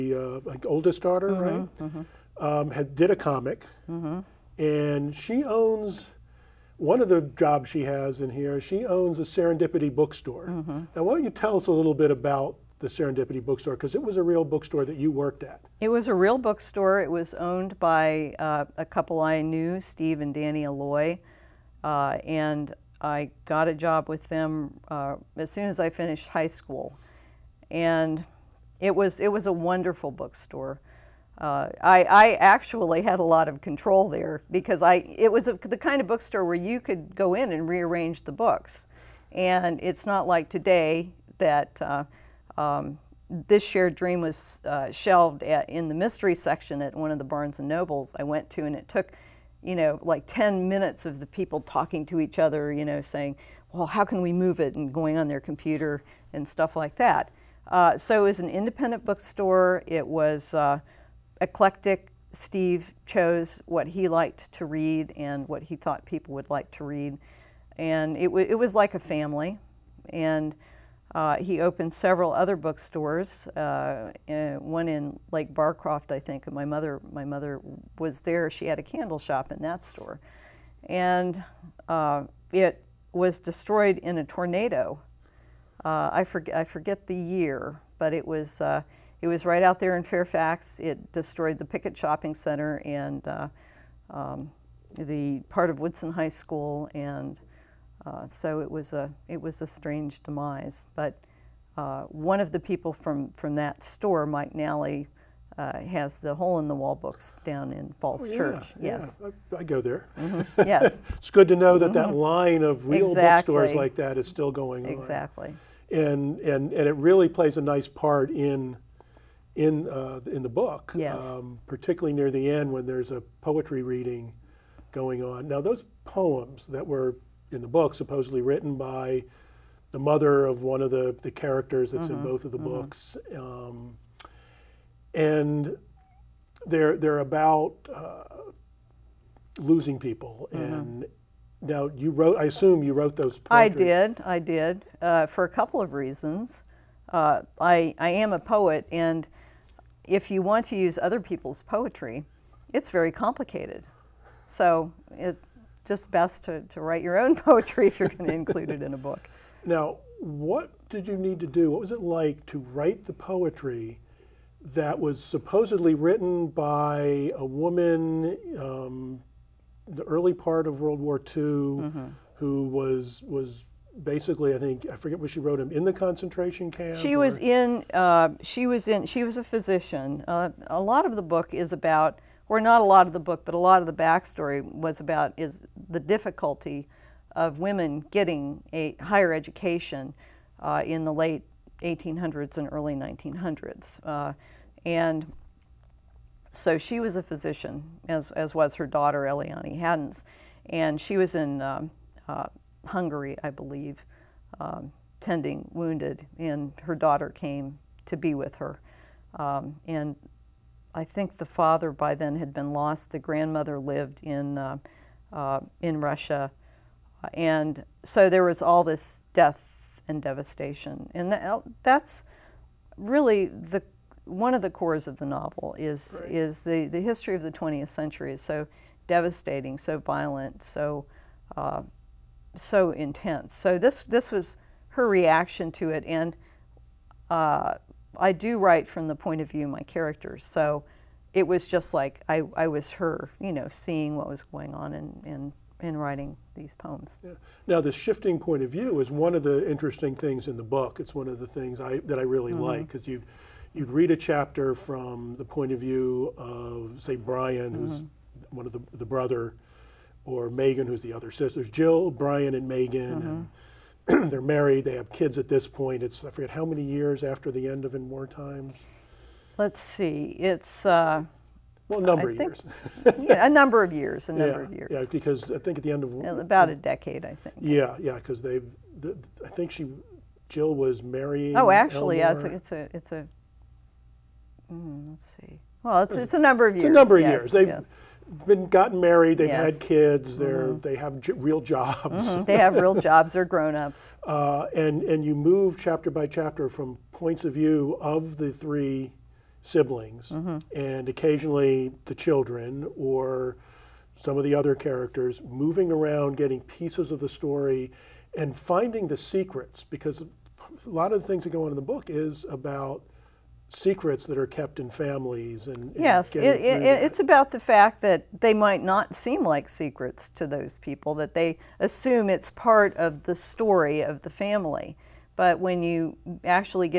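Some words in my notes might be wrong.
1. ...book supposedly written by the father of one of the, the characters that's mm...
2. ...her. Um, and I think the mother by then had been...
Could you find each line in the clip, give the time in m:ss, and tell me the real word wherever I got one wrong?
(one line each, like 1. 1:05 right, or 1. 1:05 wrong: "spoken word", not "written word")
1. 2:07 wrong: "mother", not "father"
2. 3:28 wrong: "father", not "mother".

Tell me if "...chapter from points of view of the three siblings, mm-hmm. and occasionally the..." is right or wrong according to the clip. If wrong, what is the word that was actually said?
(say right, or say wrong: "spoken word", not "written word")
right.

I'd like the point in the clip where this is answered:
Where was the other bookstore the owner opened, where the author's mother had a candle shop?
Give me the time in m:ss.
1:15.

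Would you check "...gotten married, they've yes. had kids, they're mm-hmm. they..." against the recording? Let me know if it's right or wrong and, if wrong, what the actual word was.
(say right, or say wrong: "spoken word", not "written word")
right.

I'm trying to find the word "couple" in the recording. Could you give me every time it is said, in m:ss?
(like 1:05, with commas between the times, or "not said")
0:18, 2:25.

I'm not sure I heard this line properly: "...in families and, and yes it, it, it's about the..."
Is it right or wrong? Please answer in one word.
right.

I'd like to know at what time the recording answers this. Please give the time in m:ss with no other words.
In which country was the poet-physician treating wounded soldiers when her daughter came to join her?
3:22.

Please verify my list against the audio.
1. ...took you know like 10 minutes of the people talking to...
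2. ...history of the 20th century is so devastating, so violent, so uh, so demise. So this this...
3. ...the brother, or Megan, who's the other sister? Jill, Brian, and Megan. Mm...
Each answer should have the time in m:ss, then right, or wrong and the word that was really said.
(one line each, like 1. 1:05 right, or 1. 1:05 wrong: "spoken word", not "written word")
1. 0:48 right
2. 3:46 wrong: "intense", not "demise"
3. 4:18 right.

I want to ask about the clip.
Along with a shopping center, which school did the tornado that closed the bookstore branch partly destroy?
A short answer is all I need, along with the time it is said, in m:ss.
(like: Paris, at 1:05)
Woodson High School, at 1:35.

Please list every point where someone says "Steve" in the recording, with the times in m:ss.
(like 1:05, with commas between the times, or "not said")
0:19, 1:02.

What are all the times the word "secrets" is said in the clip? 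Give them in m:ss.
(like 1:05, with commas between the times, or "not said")
5:09, 5:13, 5:19.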